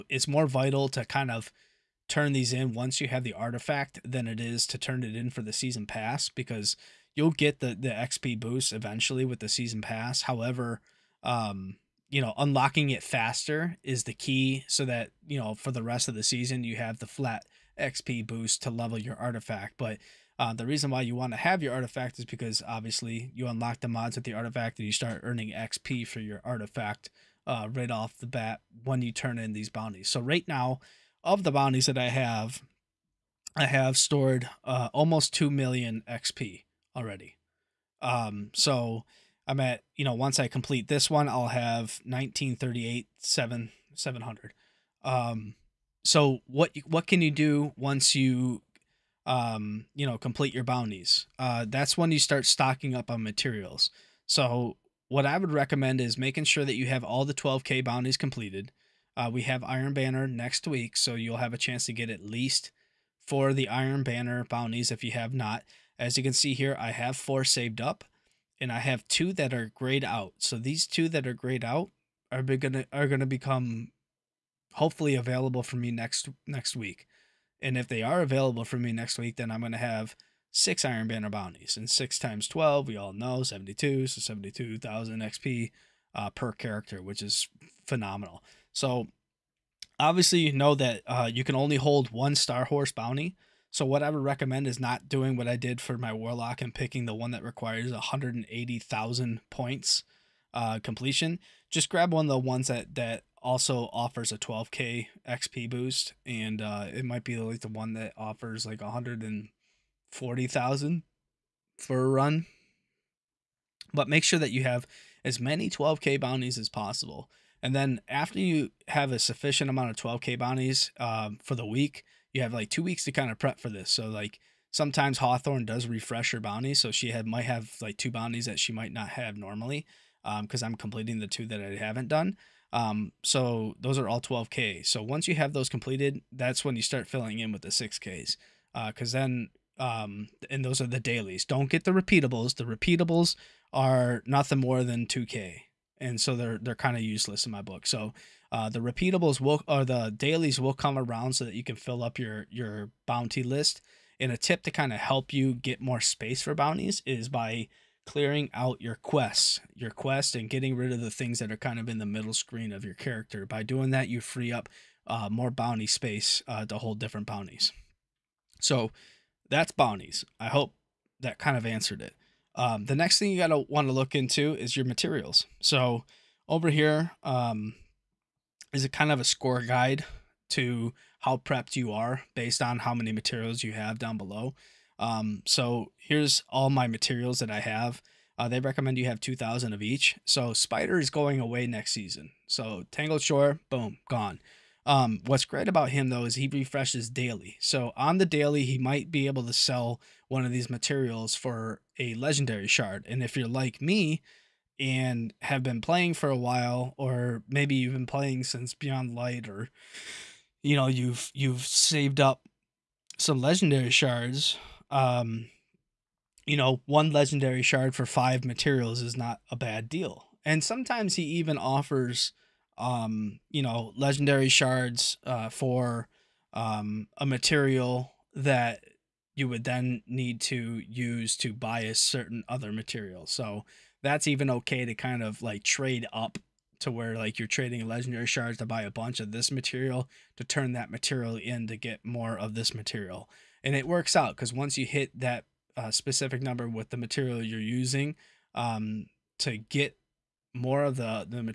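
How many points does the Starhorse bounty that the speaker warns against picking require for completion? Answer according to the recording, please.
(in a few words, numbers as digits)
180,000.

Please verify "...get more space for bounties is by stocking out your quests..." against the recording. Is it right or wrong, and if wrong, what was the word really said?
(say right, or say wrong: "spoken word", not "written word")
wrong: "clearing", not "stocking".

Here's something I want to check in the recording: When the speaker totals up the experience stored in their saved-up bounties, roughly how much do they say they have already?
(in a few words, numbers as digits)
almost 2 million XP.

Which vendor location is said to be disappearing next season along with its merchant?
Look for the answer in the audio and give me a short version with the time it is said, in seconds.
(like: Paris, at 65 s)
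Tangled Shore, at 192 s.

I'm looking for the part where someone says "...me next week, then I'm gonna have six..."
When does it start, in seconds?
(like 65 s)
78 s.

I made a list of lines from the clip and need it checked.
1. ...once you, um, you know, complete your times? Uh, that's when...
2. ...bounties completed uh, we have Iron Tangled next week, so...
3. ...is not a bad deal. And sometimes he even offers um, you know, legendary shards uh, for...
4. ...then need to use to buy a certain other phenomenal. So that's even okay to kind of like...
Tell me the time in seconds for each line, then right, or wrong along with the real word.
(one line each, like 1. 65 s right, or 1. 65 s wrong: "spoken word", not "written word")
1. 47 s wrong: "bounties", not "times"
2. 57 s wrong: "Banner", not "Tangled"
3. 219 s right
4. 229 s wrong: "material", not "phenomenal".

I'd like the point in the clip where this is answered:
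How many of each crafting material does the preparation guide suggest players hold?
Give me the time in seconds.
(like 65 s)
189 s.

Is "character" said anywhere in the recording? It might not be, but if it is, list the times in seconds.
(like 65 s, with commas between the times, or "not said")
86 s, 162 s.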